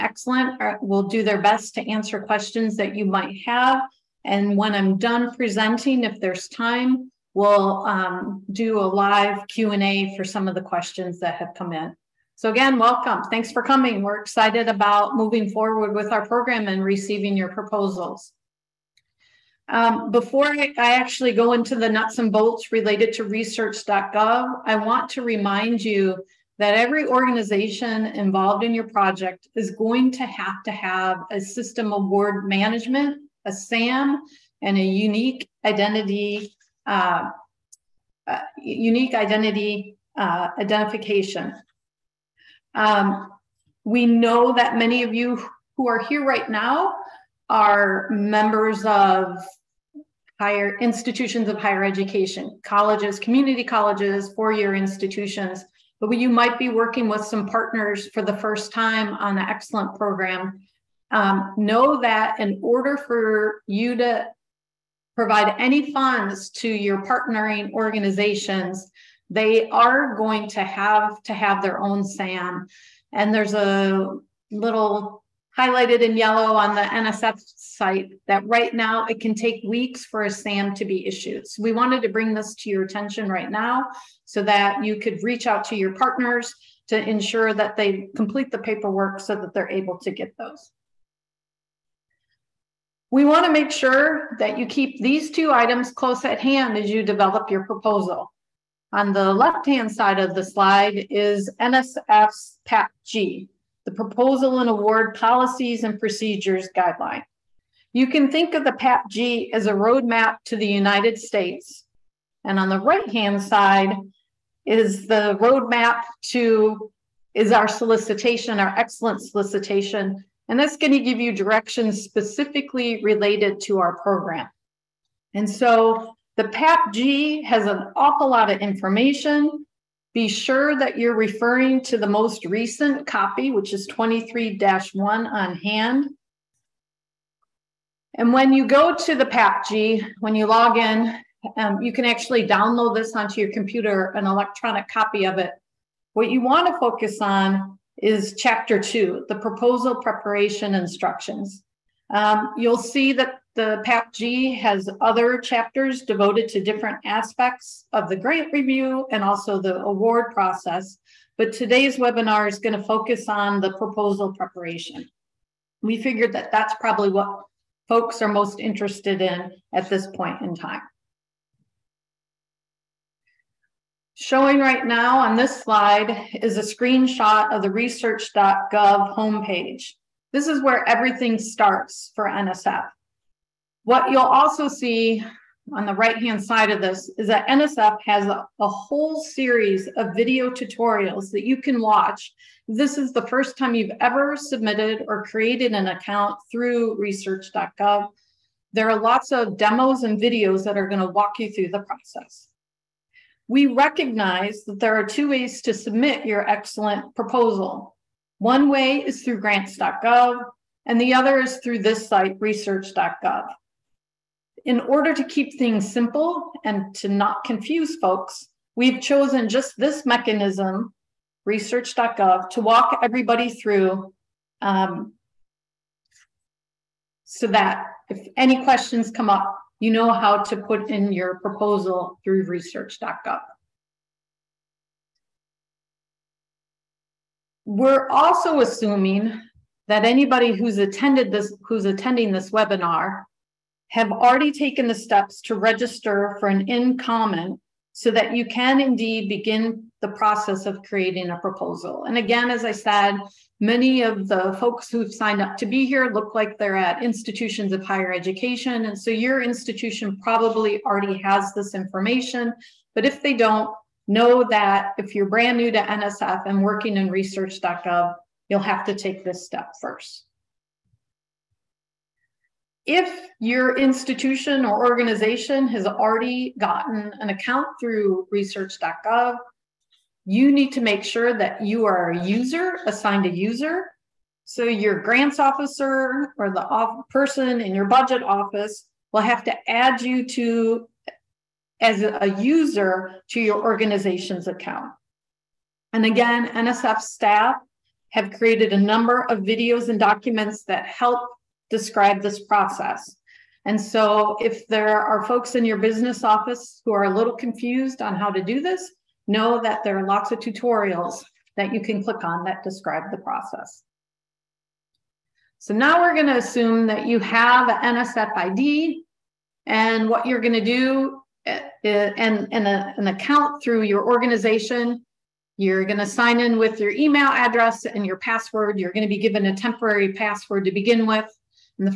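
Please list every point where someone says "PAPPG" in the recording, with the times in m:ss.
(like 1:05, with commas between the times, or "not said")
2:06, 2:19, 2:33.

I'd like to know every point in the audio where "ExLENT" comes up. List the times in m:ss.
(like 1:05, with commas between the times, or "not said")
0:59, 1:58, 3:26.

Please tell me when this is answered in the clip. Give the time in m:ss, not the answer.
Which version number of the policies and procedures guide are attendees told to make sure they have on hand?
2:13.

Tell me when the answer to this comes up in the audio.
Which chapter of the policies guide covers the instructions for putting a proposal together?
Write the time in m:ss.
2:28.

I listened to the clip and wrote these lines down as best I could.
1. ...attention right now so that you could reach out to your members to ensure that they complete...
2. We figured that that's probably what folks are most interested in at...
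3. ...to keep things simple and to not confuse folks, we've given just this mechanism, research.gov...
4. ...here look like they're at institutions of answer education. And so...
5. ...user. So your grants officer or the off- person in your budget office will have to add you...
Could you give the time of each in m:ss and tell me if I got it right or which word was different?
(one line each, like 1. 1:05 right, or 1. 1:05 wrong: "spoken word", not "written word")
1. 1:22 wrong: "partners", not "members"
2. 2:45 right
3. 3:35 wrong: "chosen", not "given"
4. 4:15 wrong: "higher", not "answer"
5. 4:43 right.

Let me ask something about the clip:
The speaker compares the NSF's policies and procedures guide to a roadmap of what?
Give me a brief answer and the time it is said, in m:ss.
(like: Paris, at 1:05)
The United States, at 1:50.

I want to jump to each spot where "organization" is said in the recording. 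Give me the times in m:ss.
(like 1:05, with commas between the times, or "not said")
0:27, 1:07, 4:34, 4:53, 5:24.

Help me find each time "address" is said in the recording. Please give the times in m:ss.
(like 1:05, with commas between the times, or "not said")
5:27.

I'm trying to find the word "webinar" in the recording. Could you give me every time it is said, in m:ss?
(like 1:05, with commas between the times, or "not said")
2:41, 4:02.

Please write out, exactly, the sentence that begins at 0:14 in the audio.
We're excited about moving forward with our program and receiving your proposals.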